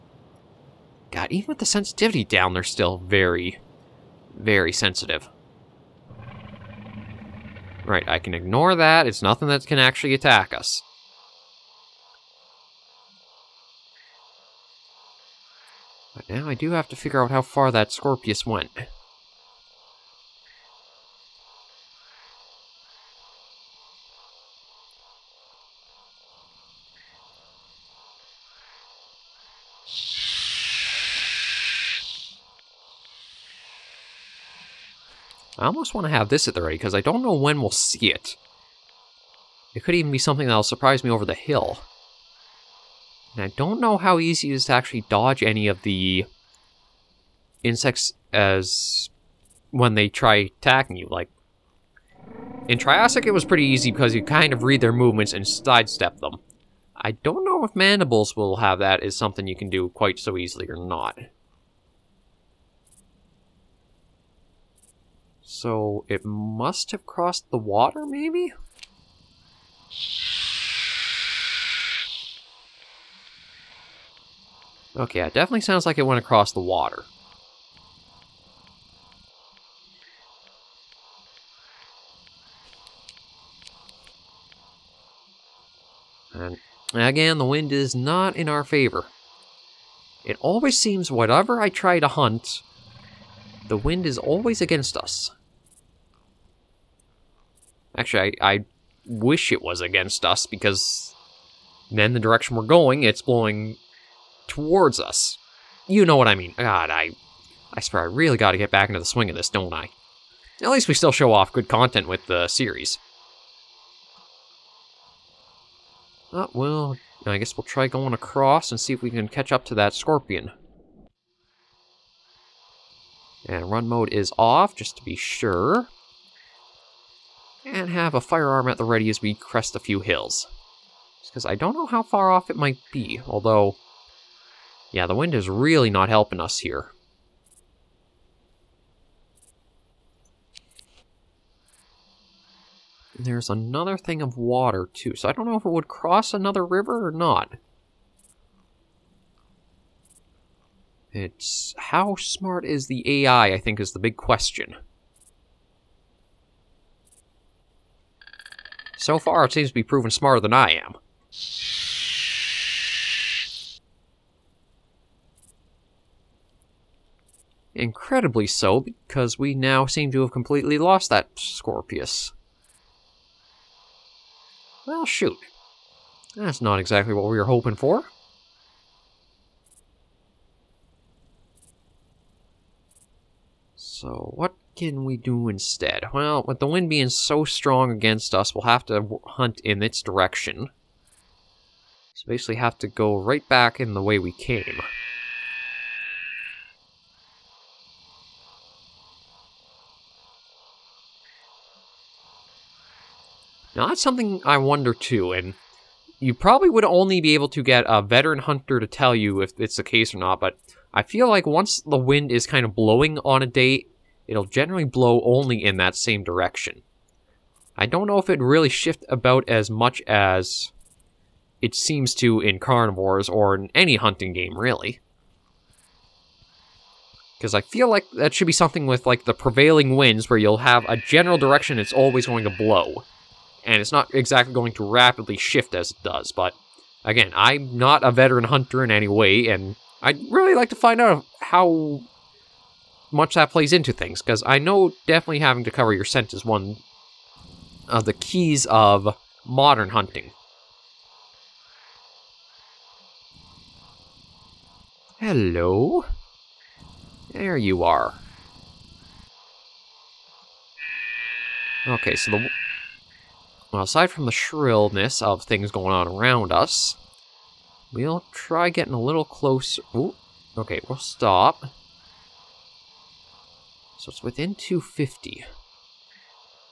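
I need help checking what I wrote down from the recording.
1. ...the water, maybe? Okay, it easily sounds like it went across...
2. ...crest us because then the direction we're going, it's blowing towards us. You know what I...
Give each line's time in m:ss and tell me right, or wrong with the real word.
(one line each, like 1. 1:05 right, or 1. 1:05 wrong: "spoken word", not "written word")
1. 1:07 wrong: "definitely", not "easily"
2. 1:39 wrong: "against", not "crest".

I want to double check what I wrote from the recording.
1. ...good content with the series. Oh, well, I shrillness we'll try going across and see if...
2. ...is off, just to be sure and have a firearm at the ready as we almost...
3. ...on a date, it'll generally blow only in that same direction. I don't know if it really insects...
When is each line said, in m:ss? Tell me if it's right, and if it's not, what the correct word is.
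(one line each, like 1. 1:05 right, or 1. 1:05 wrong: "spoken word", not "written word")
1. 1:51 wrong: "guess", not "shrillness"
2. 2:04 wrong: "crest", not "almost"
3. 3:33 wrong: "shifts", not "insects".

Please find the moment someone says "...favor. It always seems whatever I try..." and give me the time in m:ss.
1:28.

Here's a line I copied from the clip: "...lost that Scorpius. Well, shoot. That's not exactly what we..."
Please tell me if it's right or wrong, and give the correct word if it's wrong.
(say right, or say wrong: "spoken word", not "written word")
right.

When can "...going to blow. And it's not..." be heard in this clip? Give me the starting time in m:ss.
3:52.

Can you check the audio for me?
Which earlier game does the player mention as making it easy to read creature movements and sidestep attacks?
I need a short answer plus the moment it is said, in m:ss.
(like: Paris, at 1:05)
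Triassic, at 0:52.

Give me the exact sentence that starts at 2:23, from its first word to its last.
And there's another thing of water, too, so I don't know if it would cross another river or not.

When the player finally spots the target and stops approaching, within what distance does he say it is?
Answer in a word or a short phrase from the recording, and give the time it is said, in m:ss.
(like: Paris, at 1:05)
250, at 4:34.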